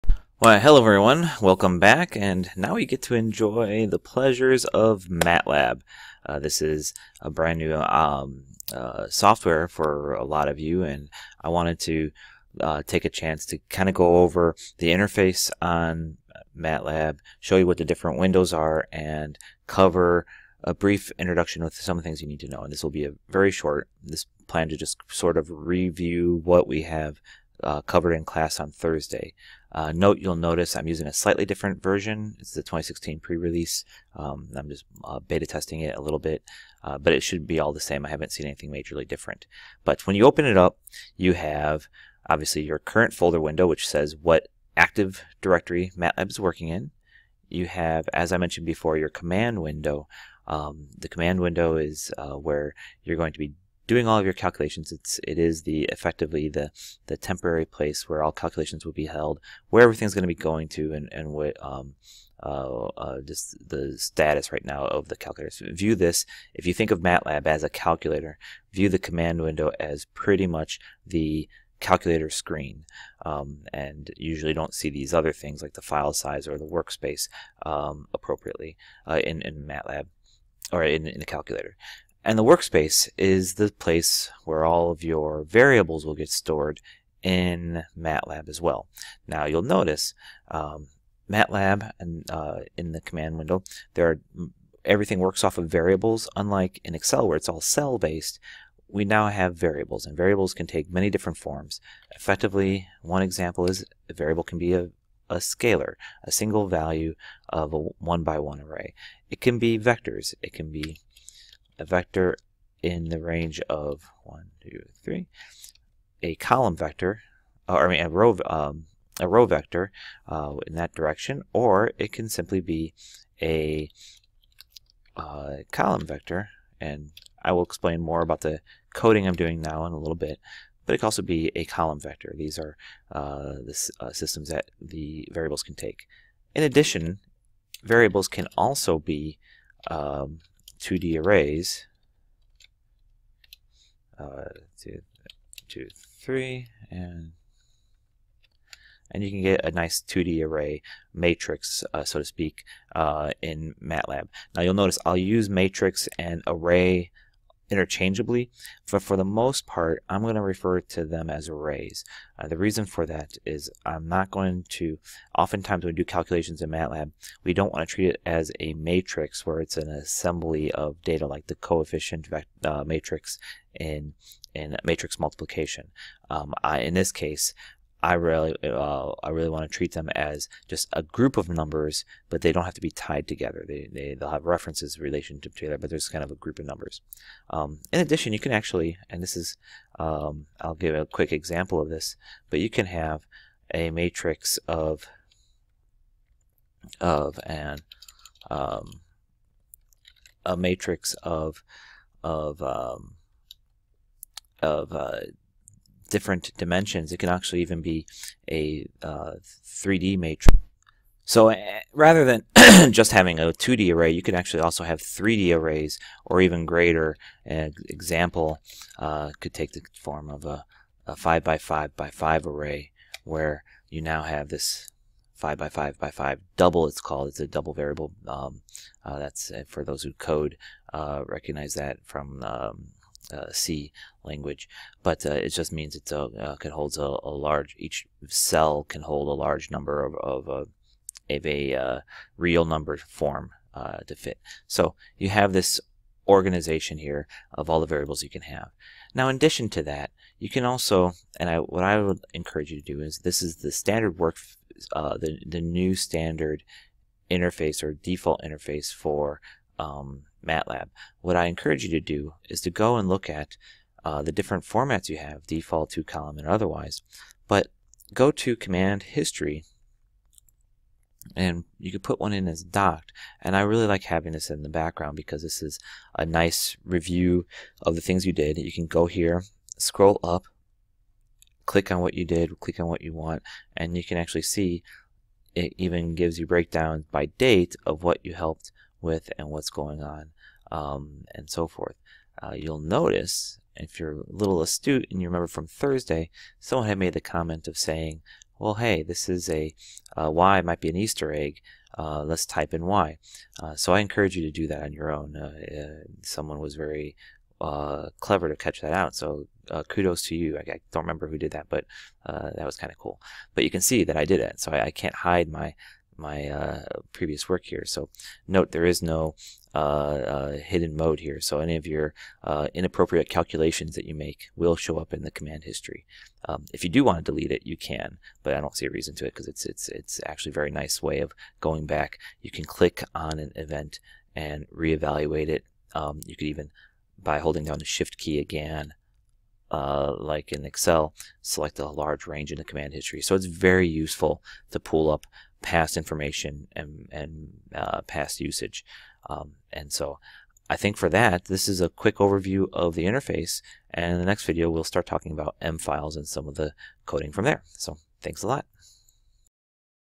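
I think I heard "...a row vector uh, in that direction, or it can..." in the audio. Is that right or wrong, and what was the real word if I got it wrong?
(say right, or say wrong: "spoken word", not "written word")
right.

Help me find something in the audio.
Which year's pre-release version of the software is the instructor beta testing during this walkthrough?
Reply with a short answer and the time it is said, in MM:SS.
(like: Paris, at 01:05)
2016, at 00:32.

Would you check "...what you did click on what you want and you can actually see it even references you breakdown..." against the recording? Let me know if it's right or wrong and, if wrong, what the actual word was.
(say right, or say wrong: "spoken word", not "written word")
wrong: "gives", not "references".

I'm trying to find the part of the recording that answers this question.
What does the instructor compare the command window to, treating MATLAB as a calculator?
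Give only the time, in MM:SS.
01:11.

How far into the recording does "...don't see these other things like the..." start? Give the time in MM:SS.
01:14.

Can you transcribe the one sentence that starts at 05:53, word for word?
And in the next video, we'll start talking about M files and some of the coding from there.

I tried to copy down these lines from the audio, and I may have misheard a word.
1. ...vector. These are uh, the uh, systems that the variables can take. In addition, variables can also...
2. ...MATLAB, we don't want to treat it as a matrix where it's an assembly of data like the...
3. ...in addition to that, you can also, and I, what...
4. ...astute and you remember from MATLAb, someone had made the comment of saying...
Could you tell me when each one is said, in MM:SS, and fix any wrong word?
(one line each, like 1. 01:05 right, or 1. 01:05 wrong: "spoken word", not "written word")
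1. 02:11 right
2. 02:46 right
3. 04:09 right
4. 04:54 wrong: "Thursday", not "MATLAb".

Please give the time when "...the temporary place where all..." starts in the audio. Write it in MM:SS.
00:57.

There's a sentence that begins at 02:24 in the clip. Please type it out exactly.
Uh, two, two, three, and and you can get a nice 2D array matrix, uh, so to speak, uh, in MATLAb.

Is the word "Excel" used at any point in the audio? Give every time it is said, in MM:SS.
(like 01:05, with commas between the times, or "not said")
01:36, 05:40.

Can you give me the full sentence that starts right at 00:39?
But when you open it up, you have obviously your current folder window, which says what active directory MATLAB is working in.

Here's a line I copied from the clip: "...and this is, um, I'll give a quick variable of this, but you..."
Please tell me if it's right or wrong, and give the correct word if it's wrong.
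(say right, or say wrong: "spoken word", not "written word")
wrong: "example", not "variable".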